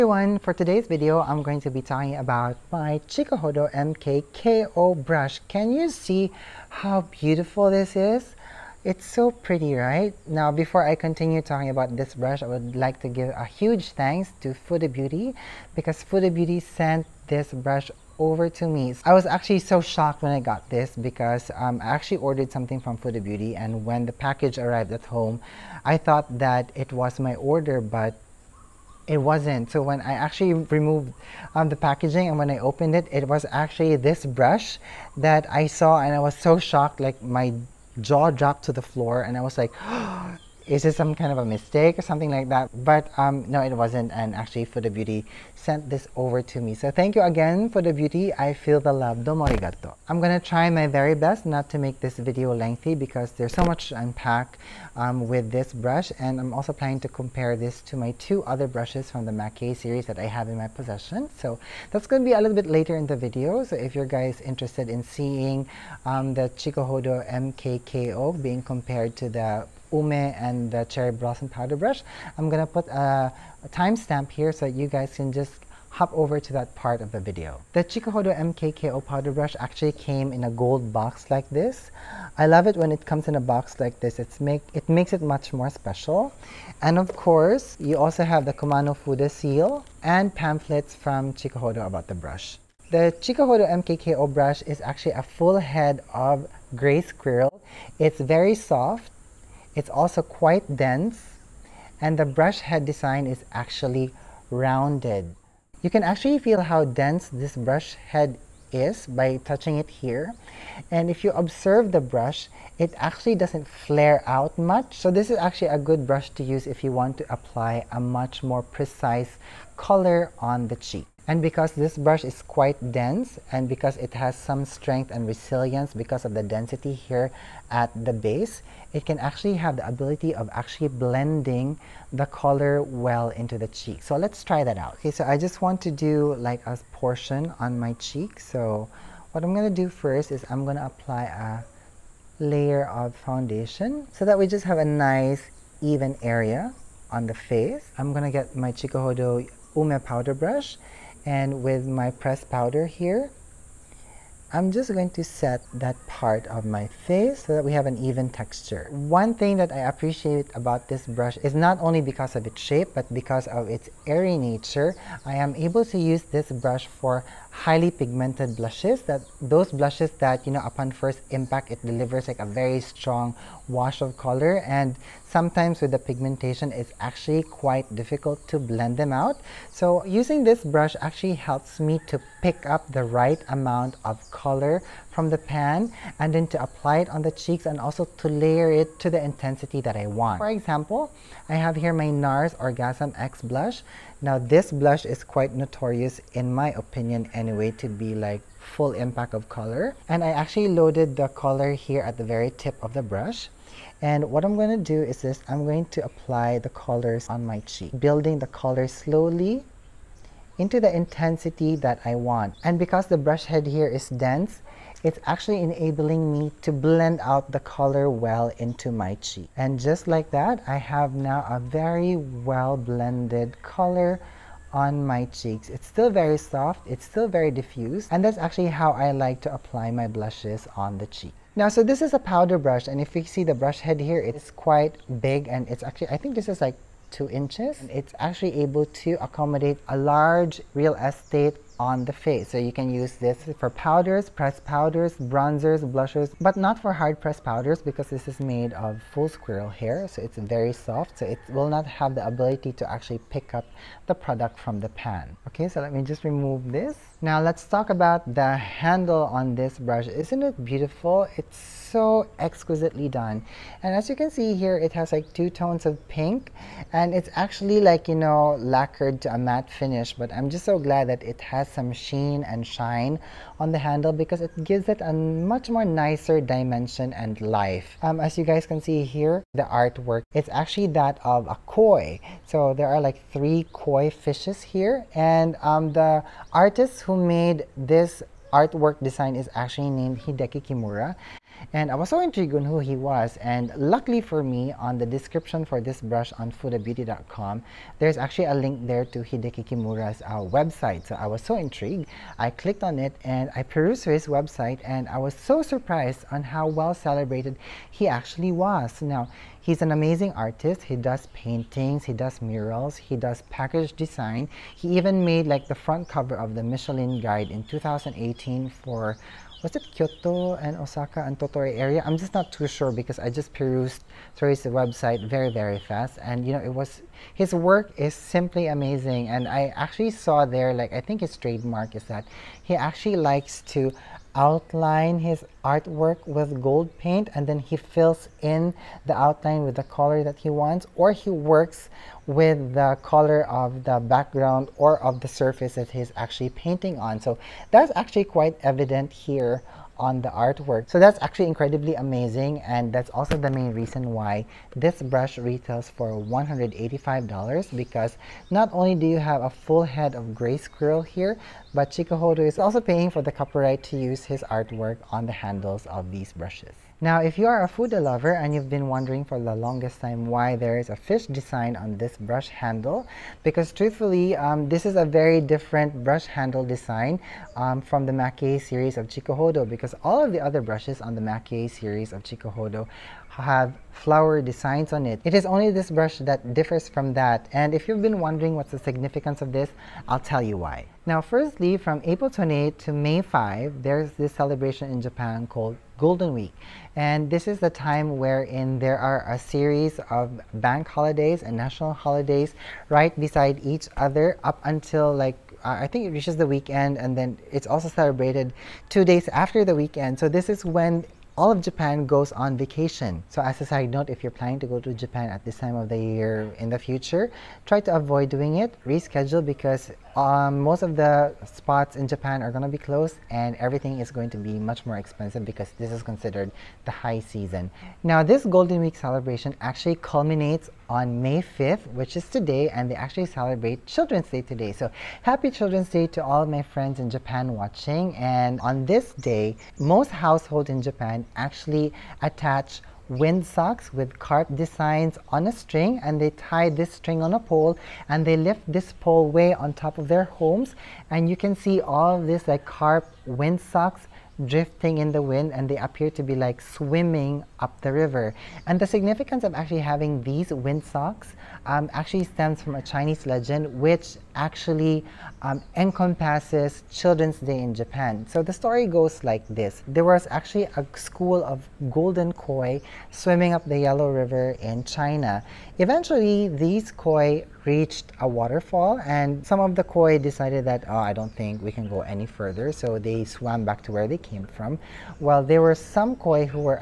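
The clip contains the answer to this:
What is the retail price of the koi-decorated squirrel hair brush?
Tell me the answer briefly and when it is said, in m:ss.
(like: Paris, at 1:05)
$185, at 5:56.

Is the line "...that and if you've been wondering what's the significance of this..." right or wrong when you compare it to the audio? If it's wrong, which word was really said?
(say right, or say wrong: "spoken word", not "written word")
right.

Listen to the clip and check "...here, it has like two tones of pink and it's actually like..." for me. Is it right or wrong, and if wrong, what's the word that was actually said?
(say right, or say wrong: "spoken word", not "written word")
right.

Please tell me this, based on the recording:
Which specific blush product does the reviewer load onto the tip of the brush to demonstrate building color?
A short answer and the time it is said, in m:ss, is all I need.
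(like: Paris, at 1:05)
NARS Orgasm X, at 3:12.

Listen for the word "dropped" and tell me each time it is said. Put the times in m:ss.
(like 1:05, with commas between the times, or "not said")
0:38.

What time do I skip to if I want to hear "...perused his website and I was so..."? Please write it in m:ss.
5:03.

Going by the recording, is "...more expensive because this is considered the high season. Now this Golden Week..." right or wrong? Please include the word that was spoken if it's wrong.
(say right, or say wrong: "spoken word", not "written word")
right.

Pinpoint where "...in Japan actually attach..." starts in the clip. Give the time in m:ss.
7:20.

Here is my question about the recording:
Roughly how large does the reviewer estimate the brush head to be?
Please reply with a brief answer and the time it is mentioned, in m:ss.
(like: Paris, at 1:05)
2 inches, at 3:57.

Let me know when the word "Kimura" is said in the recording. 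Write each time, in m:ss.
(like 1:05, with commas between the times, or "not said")
4:50, 4:59.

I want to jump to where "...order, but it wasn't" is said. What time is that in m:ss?
0:27.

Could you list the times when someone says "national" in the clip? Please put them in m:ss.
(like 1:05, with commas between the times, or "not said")
6:41.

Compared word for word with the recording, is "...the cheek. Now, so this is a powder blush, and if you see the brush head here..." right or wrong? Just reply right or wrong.
wrong.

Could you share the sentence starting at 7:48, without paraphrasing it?
So the story goes like this.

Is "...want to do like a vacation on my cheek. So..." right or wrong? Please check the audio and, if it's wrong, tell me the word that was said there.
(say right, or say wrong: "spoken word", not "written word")
wrong: "portion", not "vacation".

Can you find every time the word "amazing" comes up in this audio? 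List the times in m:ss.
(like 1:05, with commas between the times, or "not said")
5:09, 5:28, 5:51.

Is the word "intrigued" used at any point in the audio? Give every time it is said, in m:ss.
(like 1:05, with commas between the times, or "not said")
4:52, 5:01.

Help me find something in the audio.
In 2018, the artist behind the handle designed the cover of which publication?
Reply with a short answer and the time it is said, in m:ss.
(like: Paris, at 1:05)
Michelin Guide, at 5:16.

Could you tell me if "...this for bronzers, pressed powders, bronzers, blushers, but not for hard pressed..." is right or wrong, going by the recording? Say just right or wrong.
wrong.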